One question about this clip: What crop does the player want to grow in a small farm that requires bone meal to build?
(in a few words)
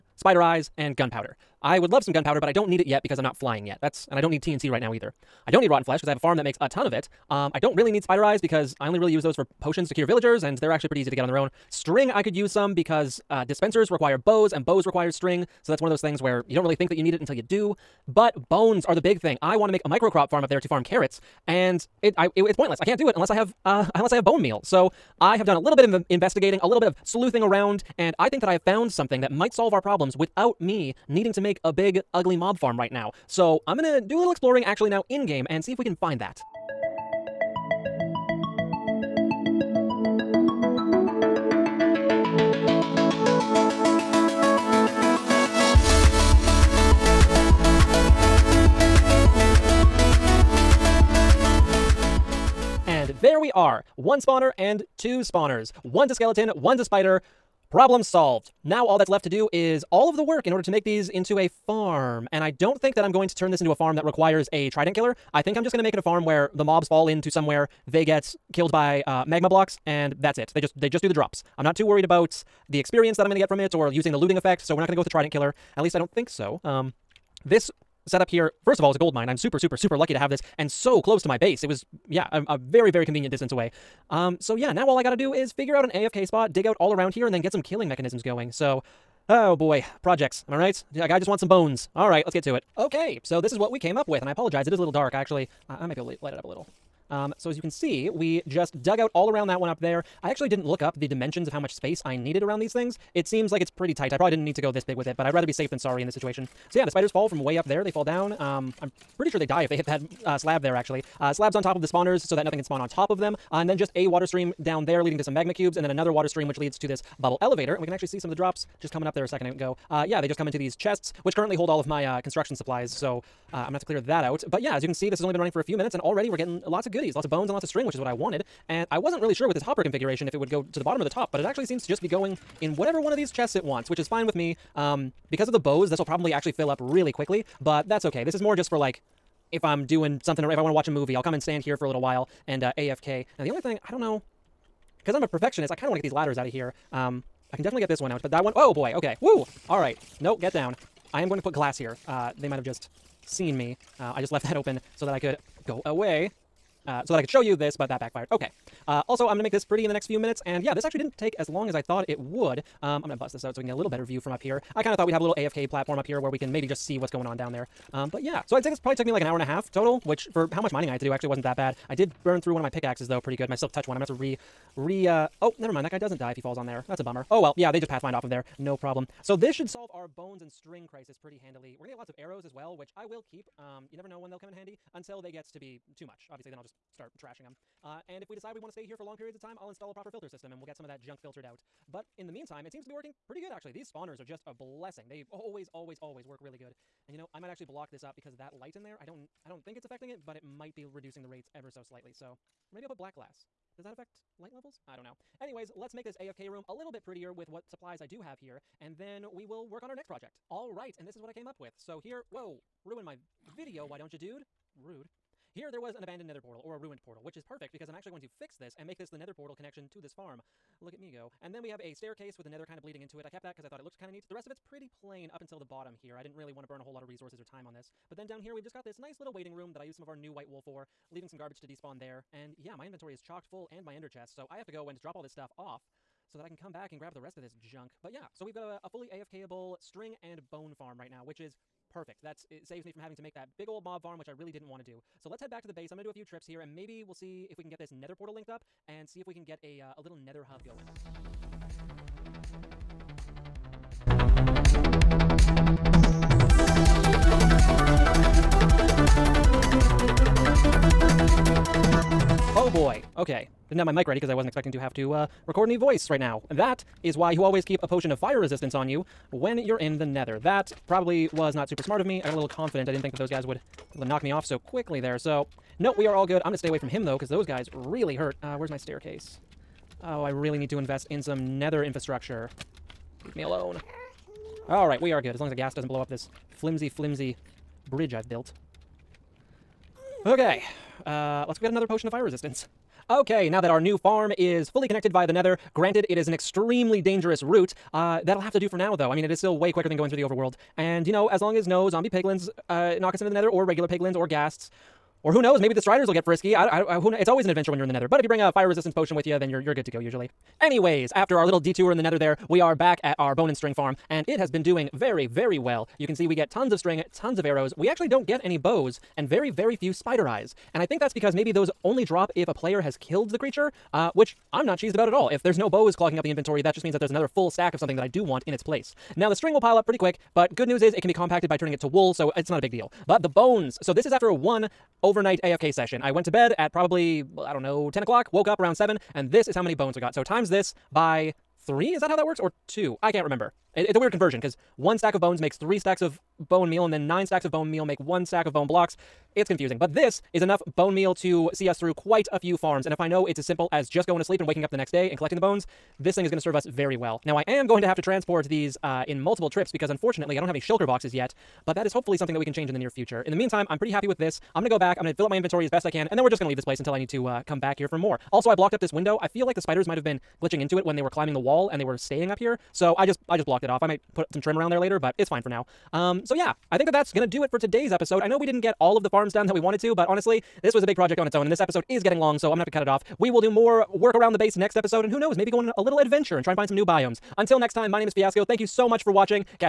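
Carrots.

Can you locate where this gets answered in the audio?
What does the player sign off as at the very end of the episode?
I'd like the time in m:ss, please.
6:28.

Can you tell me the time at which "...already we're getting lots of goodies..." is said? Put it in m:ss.
2:05.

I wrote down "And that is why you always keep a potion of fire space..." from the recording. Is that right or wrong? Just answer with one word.
wrong.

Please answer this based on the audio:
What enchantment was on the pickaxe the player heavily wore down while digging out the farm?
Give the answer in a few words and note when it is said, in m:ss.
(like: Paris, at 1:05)
Silk Touch, at 2:53.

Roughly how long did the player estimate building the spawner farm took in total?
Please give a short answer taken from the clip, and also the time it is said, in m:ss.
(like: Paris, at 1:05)
An hour and a half, at 2:49.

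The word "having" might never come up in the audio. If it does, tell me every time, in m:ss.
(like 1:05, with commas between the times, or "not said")
4:02.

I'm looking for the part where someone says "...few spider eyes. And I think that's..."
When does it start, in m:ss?
5:19.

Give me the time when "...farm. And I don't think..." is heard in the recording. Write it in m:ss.
1:01.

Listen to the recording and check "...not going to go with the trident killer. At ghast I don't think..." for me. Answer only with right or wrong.
wrong.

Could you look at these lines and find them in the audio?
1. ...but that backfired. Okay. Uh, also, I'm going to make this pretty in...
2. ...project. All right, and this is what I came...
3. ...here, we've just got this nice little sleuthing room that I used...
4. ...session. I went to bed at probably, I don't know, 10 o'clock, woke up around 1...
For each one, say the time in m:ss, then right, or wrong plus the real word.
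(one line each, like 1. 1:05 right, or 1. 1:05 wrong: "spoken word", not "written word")
1. 2:37 right
2. 3:30 right
3. 3:48 wrong: "waiting", not "sleuthing"
4. 5:35 wrong: "7", not "1".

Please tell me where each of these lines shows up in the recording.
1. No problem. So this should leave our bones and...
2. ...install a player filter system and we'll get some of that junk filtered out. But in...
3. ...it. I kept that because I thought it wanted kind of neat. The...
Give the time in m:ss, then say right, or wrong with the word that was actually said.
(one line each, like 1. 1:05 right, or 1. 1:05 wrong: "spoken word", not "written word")
1. 2:58 wrong: "solve", not "leave"
2. 3:09 wrong: "proper", not "player"
3. 3:43 wrong: "looked", not "wanted".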